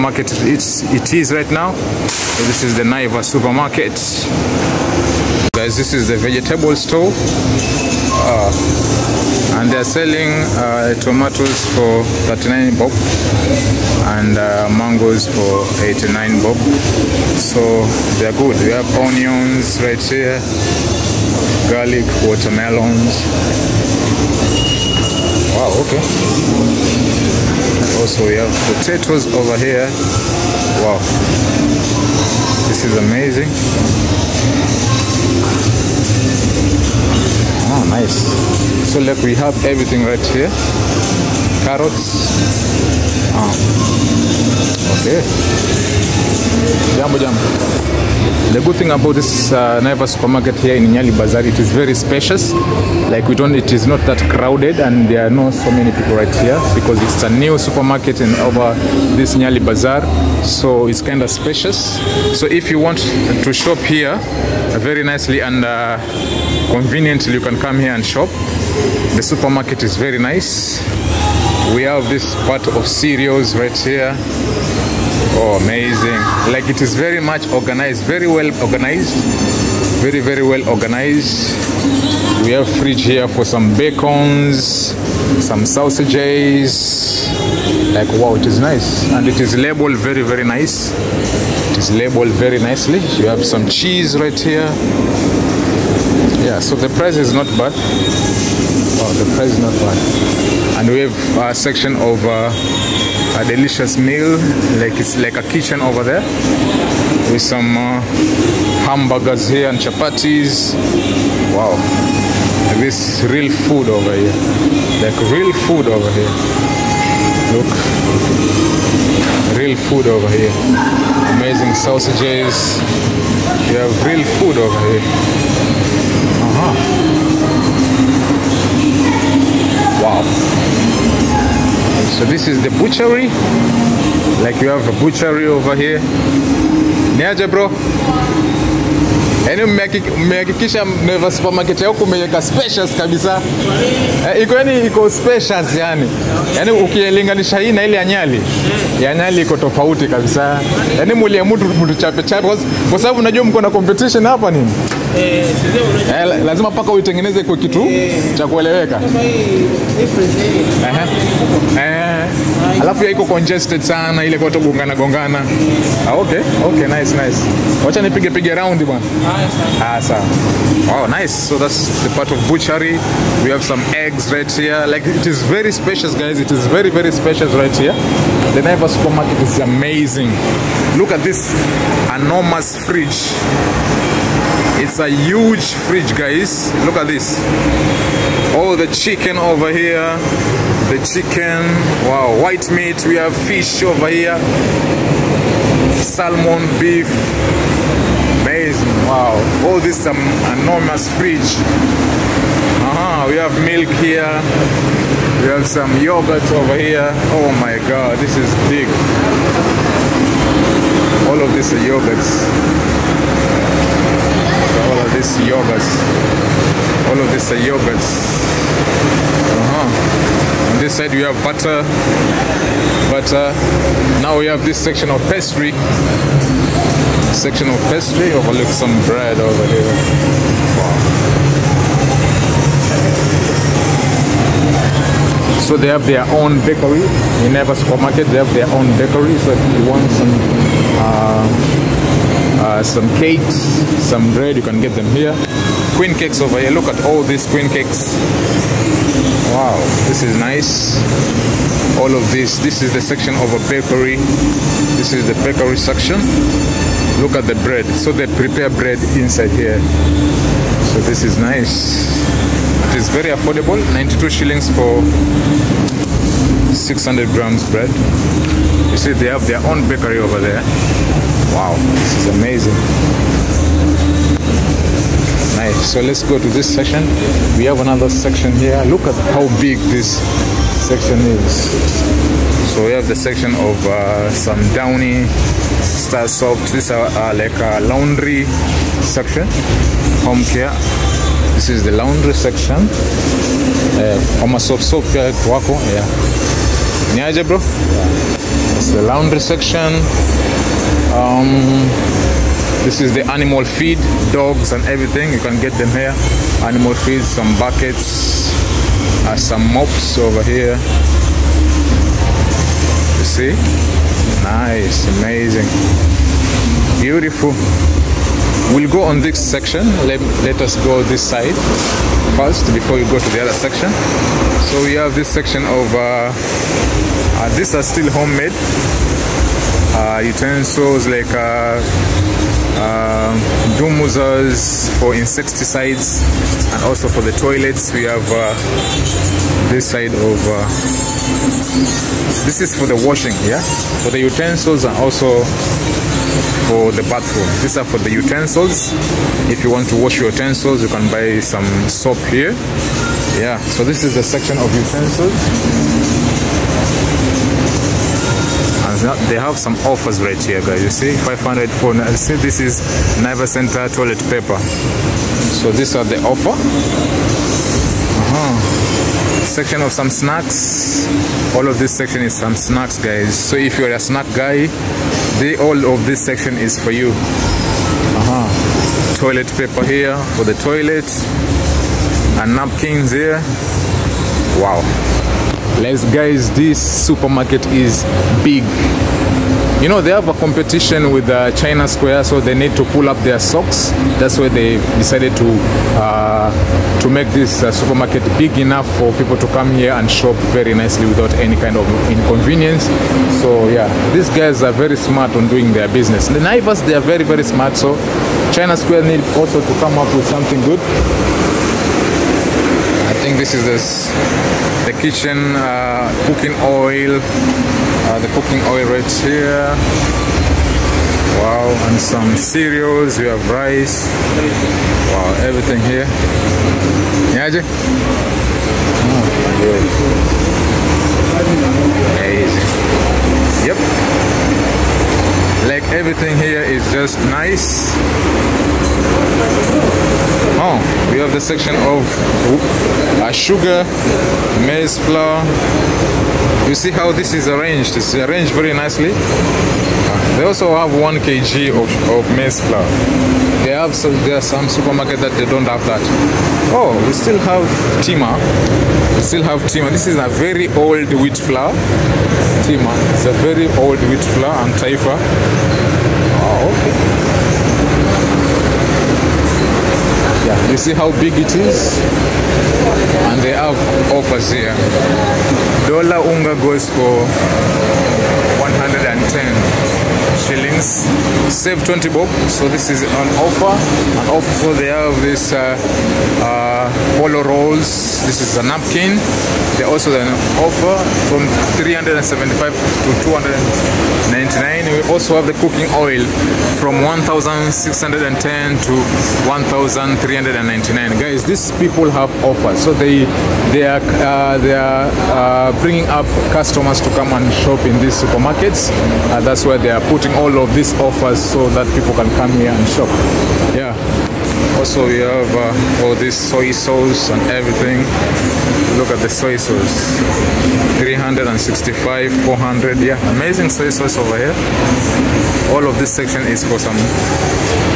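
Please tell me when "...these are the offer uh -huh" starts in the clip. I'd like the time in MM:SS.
06:05.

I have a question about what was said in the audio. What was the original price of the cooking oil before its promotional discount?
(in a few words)
1610.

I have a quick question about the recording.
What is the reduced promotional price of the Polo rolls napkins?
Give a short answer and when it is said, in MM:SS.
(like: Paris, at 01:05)
299, at 08:13.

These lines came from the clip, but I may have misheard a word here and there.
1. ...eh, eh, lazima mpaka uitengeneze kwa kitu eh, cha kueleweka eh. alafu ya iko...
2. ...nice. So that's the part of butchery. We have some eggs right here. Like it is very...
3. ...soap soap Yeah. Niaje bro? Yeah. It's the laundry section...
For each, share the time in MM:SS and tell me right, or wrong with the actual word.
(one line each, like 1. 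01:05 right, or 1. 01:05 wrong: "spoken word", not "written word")
1. 02:35 right
2. 02:51 right
3. 04:54 right.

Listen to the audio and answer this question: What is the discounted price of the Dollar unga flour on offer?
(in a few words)
110 shillings.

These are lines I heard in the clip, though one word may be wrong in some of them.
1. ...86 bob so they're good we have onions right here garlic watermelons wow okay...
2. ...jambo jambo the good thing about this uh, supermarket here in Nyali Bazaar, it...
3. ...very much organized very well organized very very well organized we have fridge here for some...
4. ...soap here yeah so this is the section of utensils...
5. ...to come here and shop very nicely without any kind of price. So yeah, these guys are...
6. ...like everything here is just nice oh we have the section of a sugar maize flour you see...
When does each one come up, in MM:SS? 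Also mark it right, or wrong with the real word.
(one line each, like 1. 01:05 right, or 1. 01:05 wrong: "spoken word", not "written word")
1. 00:15 wrong: "89", not "86"
2. 00:46 right
3. 01:16 right
4. 05:51 right
5. 06:39 wrong: "inconvenience", not "price"
6. 07:15 right.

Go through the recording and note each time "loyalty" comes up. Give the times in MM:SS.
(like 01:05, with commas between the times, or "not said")
not said.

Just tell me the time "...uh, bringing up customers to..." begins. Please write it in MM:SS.
08:25.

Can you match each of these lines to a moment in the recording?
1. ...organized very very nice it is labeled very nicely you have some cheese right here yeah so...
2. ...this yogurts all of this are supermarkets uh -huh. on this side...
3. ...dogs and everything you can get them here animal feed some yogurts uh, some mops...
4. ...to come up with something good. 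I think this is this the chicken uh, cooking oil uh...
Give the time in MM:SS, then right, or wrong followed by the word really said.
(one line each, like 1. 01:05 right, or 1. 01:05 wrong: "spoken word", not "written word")
1. 01:29 wrong: "labeled", not "organized"
2. 03:35 wrong: "yogurts", not "supermarkets"
3. 05:04 wrong: "buckets", not "yogurts"
4. 06:49 wrong: "kitchen", not "chicken".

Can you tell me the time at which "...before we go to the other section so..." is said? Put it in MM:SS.
05:22.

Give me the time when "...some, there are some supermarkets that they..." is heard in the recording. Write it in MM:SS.
07:33.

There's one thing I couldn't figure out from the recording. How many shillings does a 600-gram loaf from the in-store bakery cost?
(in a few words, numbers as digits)
92 shillings.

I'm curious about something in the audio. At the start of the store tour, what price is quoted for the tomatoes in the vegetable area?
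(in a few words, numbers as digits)
39 bob.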